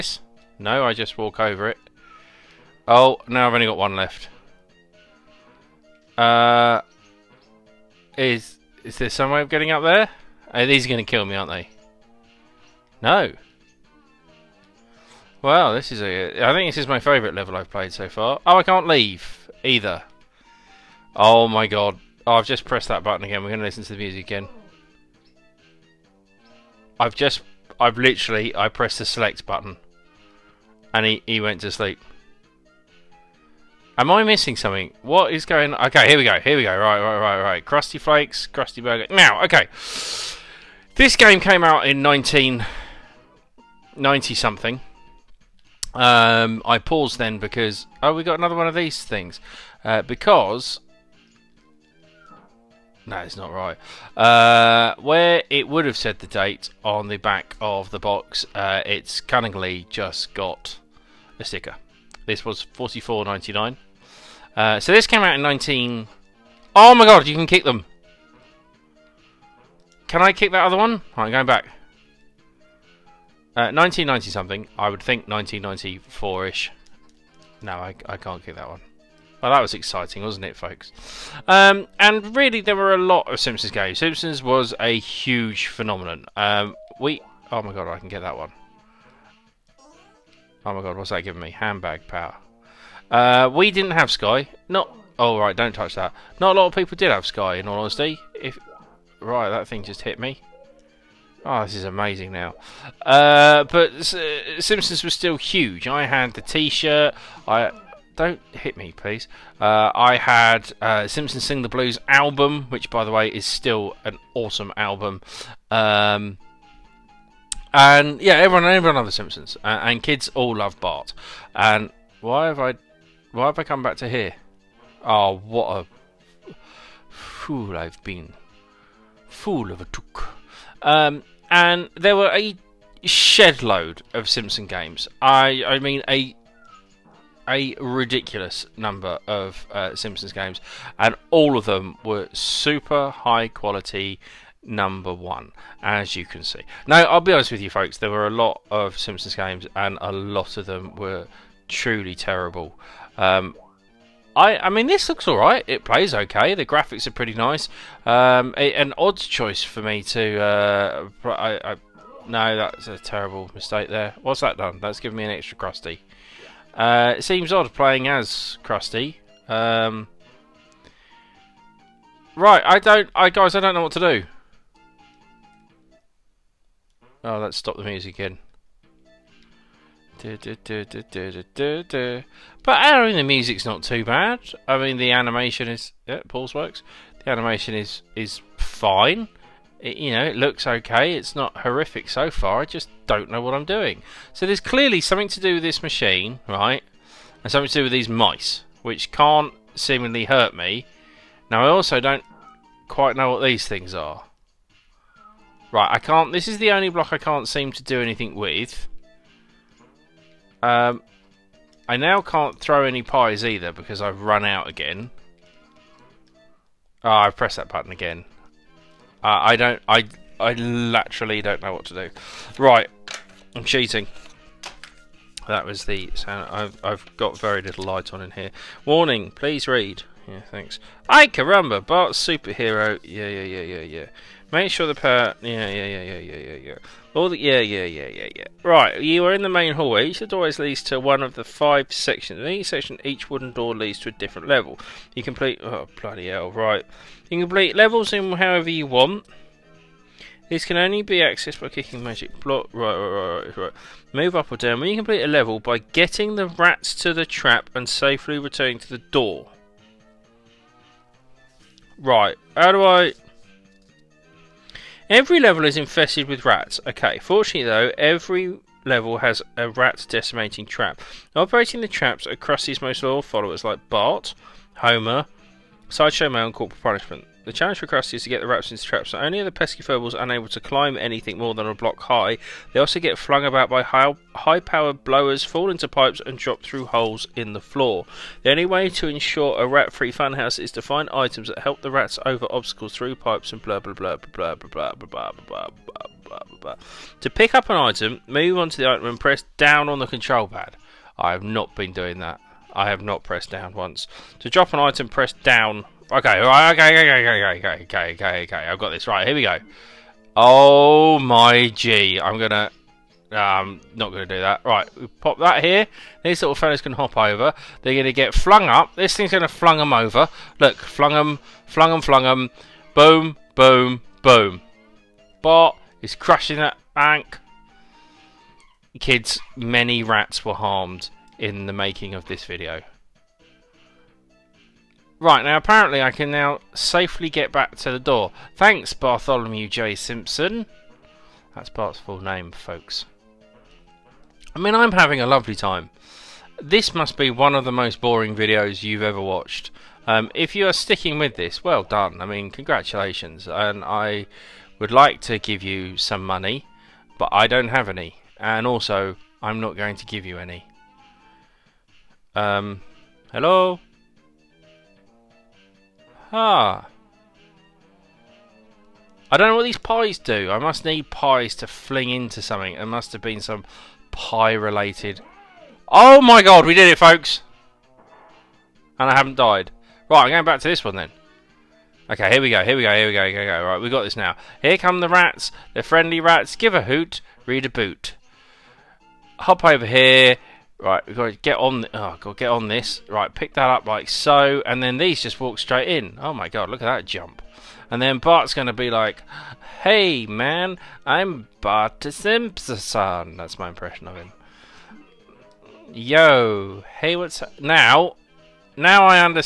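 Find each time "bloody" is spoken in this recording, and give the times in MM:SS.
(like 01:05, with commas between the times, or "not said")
04:06.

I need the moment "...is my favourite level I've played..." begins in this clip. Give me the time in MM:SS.
00:16.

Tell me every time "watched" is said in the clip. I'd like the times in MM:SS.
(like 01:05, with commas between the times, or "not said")
05:49.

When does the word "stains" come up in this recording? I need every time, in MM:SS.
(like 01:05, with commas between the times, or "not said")
not said.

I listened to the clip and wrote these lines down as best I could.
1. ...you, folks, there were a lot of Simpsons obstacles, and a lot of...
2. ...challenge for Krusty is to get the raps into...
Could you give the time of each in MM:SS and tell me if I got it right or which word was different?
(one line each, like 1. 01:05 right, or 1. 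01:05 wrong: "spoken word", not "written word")
1. 02:27 wrong: "games", not "obstacles"
2. 04:37 right.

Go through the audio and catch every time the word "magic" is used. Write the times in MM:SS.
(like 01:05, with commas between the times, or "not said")
04:12.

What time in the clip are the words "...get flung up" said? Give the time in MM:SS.
05:18.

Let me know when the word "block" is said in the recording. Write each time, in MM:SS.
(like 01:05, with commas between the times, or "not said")
03:26, 04:12, 04:41.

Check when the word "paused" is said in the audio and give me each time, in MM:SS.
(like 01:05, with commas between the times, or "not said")
00:46.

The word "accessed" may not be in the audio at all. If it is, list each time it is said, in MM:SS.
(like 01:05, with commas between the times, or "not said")
04:11.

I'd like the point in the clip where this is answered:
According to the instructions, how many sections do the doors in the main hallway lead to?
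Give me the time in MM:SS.
04:01.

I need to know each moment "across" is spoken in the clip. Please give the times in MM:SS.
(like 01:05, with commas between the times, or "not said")
04:32.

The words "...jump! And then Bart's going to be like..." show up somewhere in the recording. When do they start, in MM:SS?
06:37.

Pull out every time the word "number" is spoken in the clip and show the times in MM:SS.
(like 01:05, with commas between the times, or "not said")
02:18, 02:24.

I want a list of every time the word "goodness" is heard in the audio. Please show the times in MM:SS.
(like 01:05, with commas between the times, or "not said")
not said.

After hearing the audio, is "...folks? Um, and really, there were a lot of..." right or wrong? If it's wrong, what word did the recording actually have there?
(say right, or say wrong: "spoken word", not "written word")
right.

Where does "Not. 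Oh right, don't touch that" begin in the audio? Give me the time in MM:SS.
01:34.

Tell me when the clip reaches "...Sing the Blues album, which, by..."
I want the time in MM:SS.
01:51.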